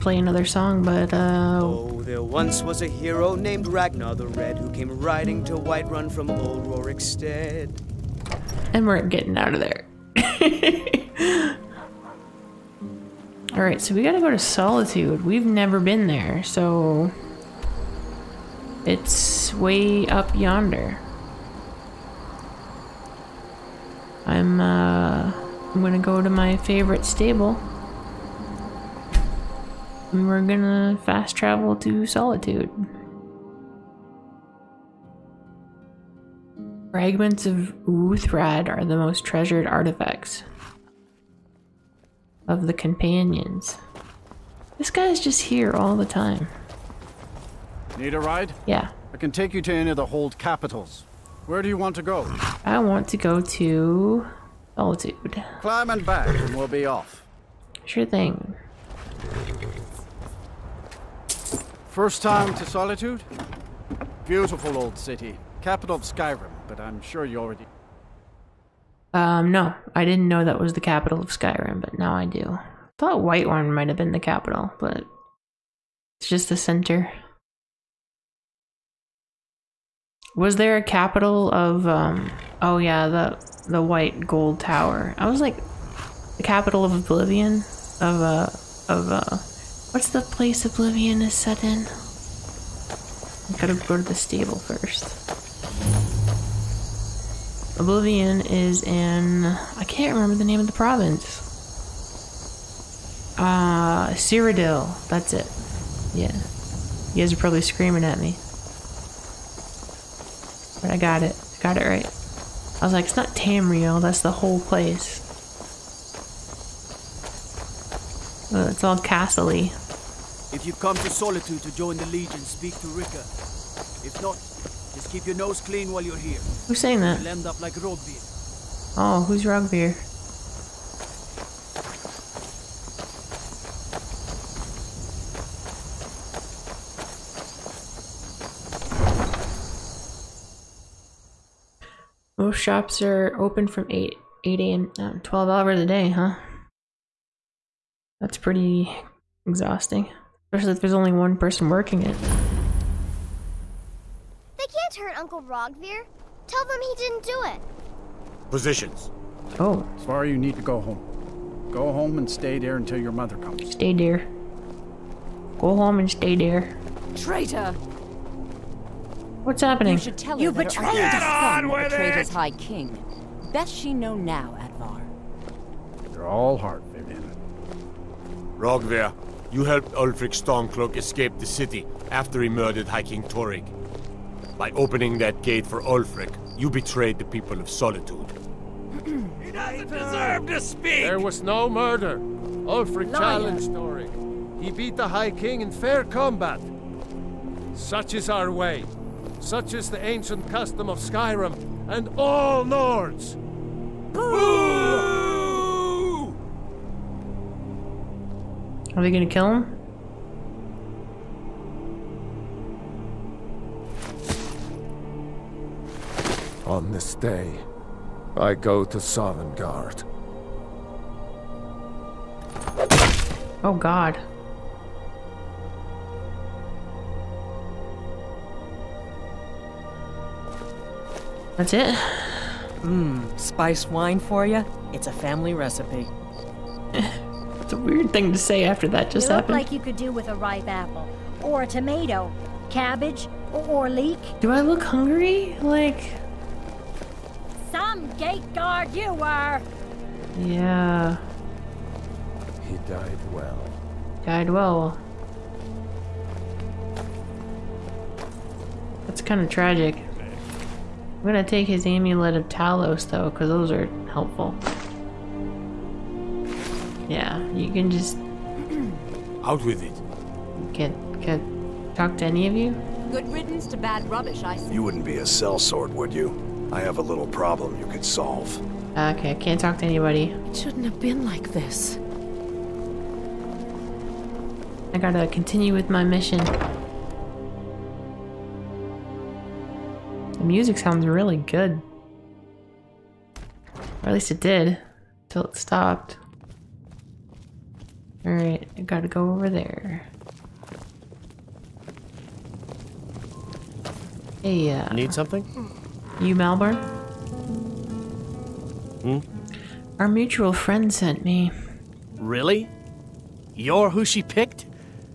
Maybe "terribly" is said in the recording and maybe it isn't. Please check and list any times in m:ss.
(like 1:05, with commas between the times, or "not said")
not said.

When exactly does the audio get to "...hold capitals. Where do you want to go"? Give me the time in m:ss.
0:50.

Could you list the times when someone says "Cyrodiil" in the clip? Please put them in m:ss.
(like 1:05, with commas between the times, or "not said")
1:44.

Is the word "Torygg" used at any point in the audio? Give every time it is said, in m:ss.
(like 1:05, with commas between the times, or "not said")
3:03, 3:13.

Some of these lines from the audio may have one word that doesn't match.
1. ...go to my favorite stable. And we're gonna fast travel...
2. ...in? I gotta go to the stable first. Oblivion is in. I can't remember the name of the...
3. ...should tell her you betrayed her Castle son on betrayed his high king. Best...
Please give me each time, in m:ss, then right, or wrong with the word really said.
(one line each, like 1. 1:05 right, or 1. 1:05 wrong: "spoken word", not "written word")
1. 0:25 right
2. 1:31 right
3. 2:49 wrong: "Get", not "Castle".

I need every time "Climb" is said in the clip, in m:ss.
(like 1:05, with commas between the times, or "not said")
0:55.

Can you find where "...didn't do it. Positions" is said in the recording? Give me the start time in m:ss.
2:36.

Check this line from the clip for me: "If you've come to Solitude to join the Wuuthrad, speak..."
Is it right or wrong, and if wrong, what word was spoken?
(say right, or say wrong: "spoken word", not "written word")
wrong: "Legion", not "Wuuthrad".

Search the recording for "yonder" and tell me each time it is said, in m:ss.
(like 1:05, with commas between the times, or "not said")
0:20.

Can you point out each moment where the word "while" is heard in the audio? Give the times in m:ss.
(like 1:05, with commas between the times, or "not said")
2:05.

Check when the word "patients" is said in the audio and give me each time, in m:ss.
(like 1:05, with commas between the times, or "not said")
not said.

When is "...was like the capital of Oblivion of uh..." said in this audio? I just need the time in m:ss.
1:25.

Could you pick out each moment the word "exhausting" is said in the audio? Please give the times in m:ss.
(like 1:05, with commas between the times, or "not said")
2:29.